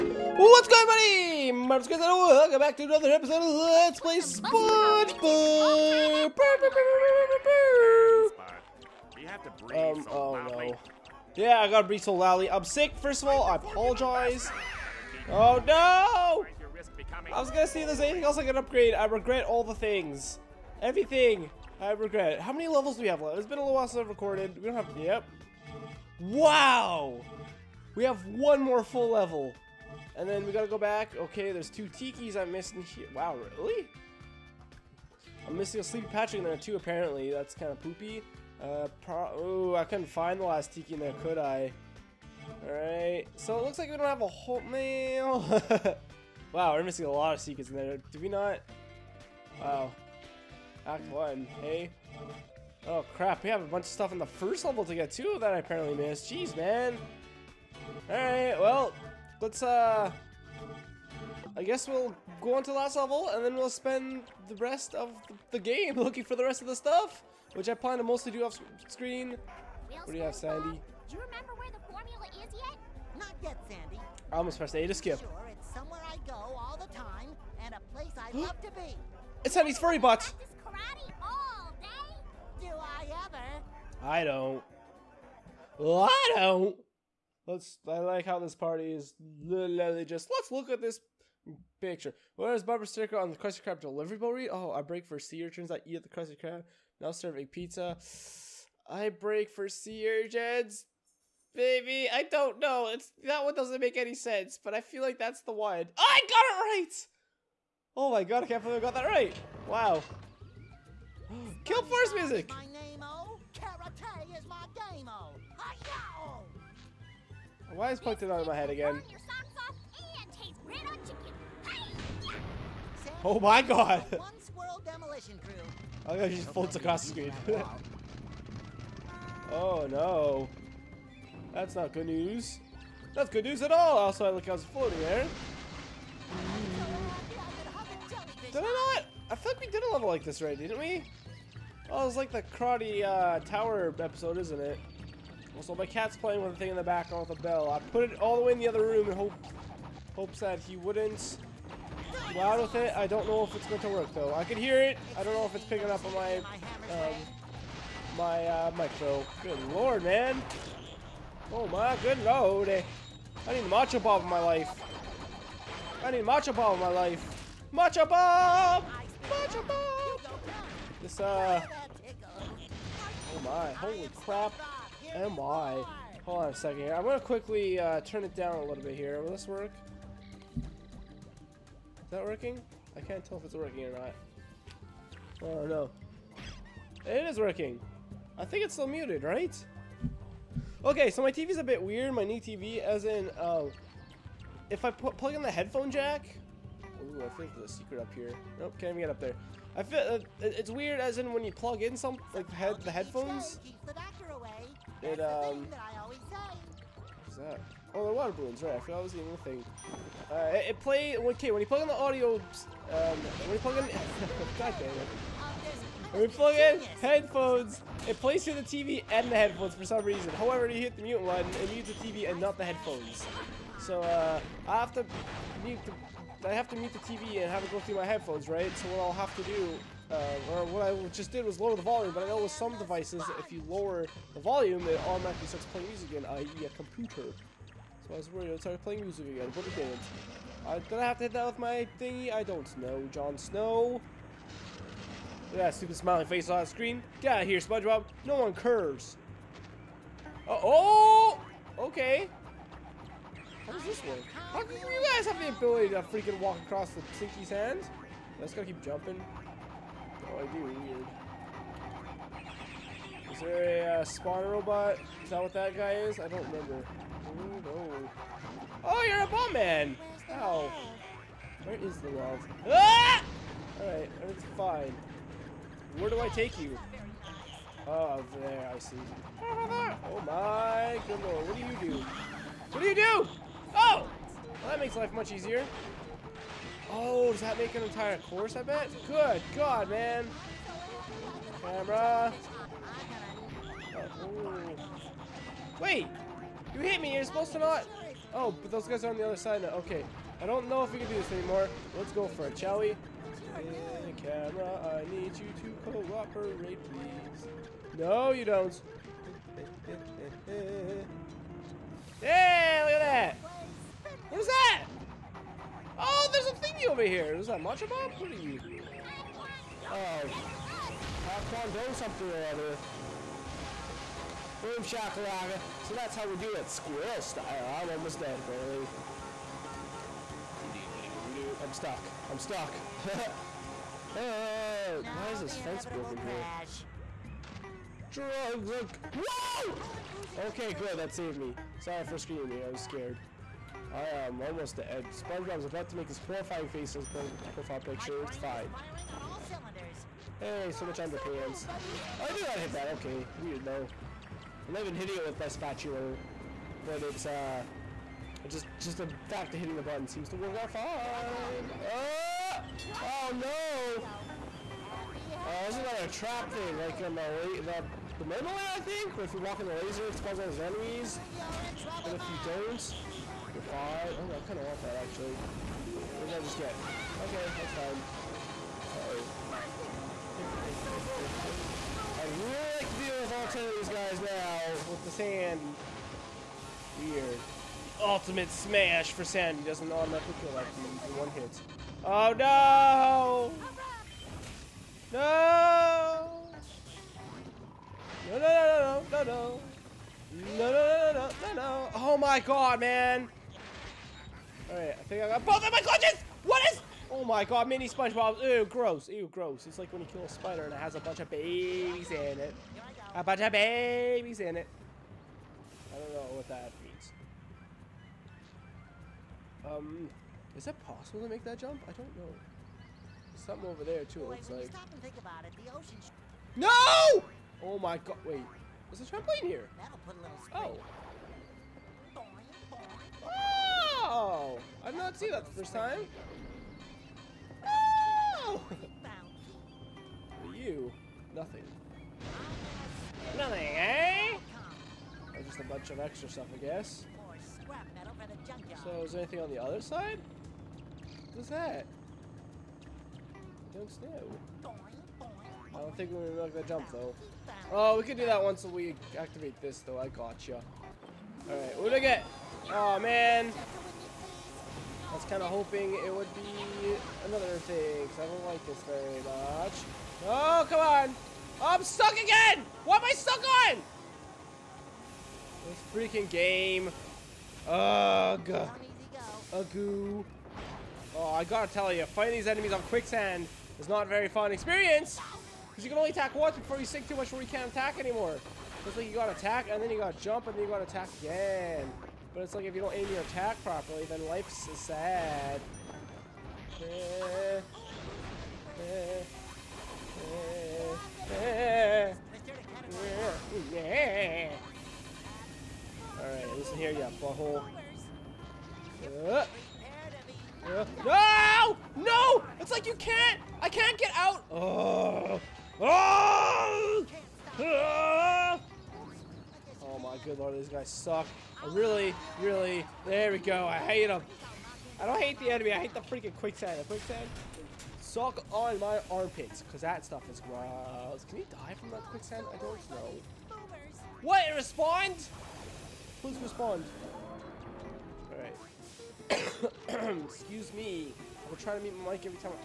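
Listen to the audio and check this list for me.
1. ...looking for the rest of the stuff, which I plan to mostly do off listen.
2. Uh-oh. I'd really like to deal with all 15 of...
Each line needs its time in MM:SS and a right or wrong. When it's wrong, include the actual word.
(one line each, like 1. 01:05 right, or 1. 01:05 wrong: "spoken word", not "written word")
1. 01:05 wrong: "screen", not "listen"
2. 06:21 wrong: "10", not "15".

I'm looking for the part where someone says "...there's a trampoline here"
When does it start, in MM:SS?
07:08.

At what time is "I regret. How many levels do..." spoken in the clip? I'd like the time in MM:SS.
00:21.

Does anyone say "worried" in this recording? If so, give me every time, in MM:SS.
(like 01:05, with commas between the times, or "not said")
03:58.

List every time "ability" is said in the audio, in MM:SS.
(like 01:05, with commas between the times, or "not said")
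04:15.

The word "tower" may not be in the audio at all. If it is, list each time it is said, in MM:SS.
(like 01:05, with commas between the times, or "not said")
02:23.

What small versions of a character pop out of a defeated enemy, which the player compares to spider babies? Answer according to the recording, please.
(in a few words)
mini SpongeBob.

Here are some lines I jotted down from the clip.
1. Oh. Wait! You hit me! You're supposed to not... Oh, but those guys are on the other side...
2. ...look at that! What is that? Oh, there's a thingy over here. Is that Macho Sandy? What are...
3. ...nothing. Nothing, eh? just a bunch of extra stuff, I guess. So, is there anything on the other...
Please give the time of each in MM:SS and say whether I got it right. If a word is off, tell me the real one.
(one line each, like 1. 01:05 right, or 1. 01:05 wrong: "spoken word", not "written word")
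1. 04:53 right
2. 05:12 wrong: "Bob", not "Sandy"
3. 07:21 right.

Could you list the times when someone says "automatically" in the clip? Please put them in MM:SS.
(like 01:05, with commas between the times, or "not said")
03:55, 06:29.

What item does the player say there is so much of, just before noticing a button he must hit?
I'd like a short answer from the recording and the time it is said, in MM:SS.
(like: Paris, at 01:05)
underpants, at 05:50.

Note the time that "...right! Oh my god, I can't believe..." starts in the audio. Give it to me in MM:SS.
01:46.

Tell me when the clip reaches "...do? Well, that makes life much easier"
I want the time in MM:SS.
04:42.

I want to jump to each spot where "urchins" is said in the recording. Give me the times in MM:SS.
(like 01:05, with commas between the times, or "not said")
01:35, 01:40.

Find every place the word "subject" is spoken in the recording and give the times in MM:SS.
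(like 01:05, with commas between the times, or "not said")
not said.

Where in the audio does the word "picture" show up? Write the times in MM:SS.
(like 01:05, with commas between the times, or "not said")
01:31, 05:47.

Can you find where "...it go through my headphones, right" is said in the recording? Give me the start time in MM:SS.
03:47.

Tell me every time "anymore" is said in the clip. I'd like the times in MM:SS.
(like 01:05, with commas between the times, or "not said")
05:01, 08:07.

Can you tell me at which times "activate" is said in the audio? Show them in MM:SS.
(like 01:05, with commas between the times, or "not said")
07:39.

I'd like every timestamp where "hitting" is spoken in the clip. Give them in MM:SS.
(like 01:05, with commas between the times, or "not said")
05:54, 05:59.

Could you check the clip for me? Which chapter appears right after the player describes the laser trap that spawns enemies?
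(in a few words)
Chapter 5.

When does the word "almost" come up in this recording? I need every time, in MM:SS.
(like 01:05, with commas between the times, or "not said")
01:14, 05:27, 05:44.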